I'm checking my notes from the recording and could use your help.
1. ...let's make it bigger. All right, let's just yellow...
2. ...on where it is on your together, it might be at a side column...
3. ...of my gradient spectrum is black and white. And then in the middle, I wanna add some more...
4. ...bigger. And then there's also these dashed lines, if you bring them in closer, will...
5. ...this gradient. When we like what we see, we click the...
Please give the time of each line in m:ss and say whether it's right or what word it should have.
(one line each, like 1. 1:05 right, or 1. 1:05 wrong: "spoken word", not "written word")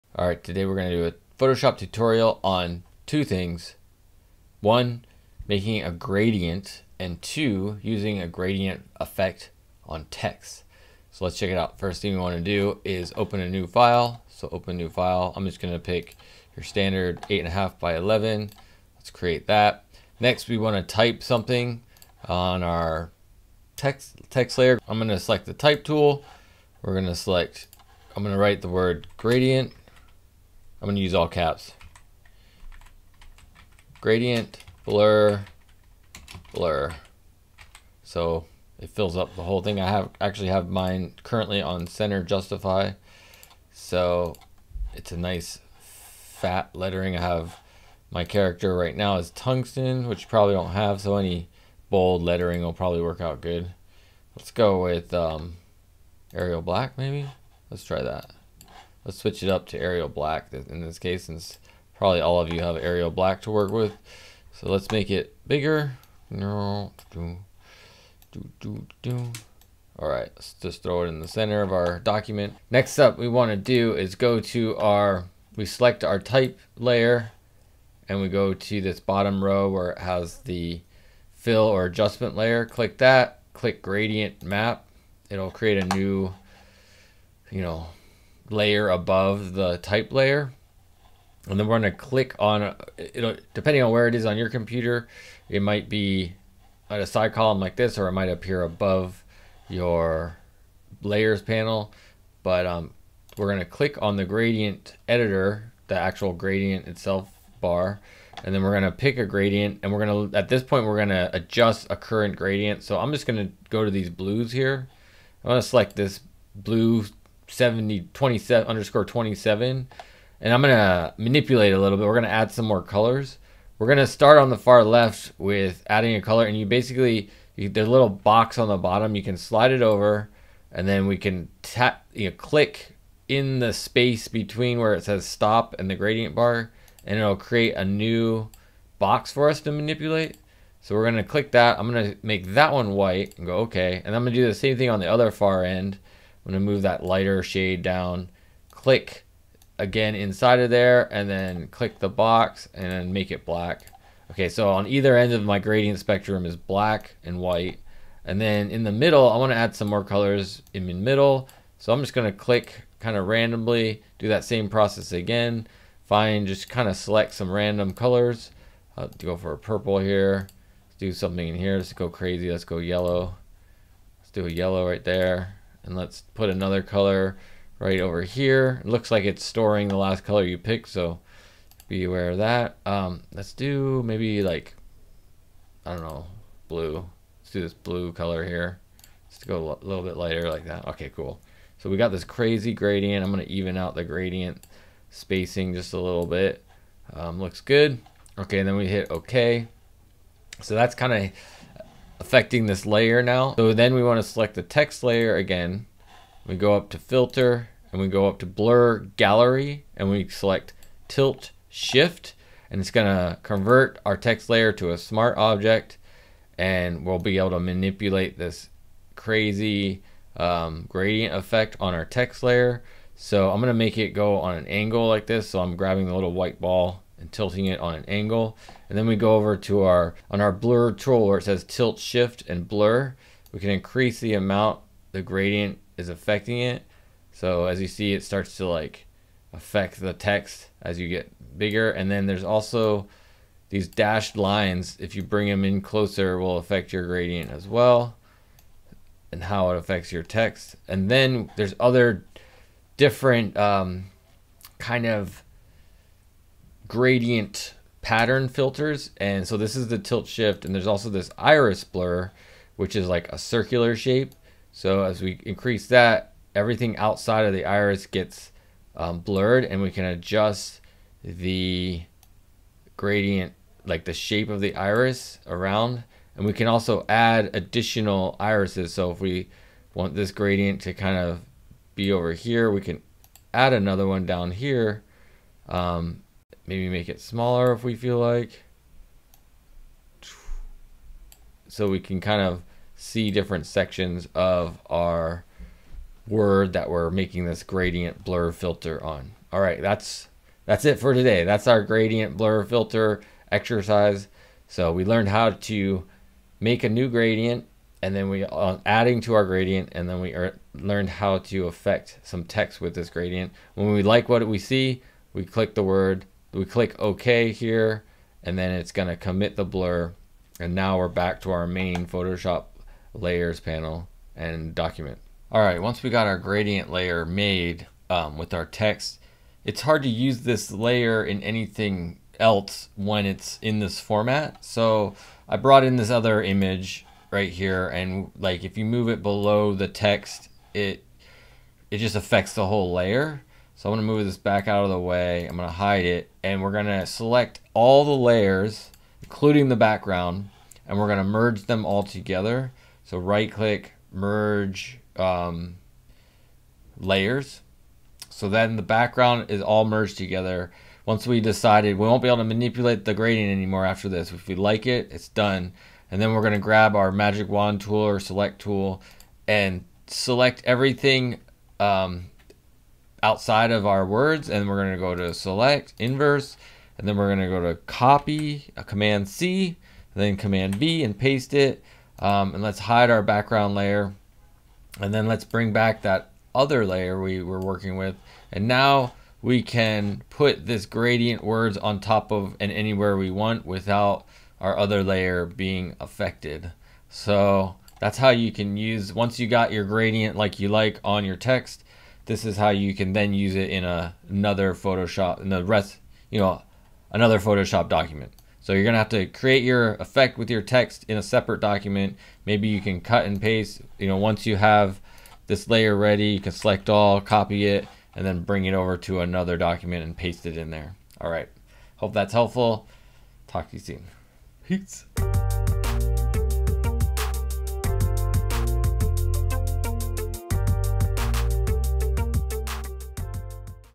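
1. 1:04 wrong: "throw", not "yellow"
2. 1:33 wrong: "computer", not "together"
3. 2:35 right
4. 4:01 right
5. 5:12 right.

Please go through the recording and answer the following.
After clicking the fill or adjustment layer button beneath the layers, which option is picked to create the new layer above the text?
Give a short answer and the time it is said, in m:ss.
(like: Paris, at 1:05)
Gradient map, at 1:23.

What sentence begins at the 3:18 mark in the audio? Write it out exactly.
Okay, and then we hit okay.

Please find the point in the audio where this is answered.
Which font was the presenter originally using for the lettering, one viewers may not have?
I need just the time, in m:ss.
0:49.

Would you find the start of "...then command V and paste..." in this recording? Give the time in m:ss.
6:20.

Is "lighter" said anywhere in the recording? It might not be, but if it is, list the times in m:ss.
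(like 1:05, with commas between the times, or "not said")
2:27, 3:10.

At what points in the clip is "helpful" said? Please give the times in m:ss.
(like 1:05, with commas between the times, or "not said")
7:02.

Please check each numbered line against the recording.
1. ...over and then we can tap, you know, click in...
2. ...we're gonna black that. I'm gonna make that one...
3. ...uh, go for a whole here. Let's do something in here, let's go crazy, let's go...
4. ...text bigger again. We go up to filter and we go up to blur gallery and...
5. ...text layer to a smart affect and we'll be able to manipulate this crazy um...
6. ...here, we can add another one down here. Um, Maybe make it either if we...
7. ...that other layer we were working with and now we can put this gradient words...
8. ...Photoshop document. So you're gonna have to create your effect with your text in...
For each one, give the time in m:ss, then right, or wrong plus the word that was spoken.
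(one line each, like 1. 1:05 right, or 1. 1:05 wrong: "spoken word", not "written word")
1. 2:09 right
2. 2:20 wrong: "click", not "black"
3. 2:49 wrong: "purple", not "whole"
4. 3:24 wrong: "layer", not "bigger"
5. 3:34 wrong: "object", not "affect"
6. 4:42 wrong: "smaller", not "either"
7. 6:26 right
8. 6:47 right.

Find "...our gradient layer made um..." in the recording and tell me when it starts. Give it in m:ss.
5:26.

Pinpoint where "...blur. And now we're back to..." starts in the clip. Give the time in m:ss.
5:19.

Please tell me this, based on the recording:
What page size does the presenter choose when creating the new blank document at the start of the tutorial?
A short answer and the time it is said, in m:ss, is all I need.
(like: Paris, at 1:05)
8.5 by 11, at 0:17.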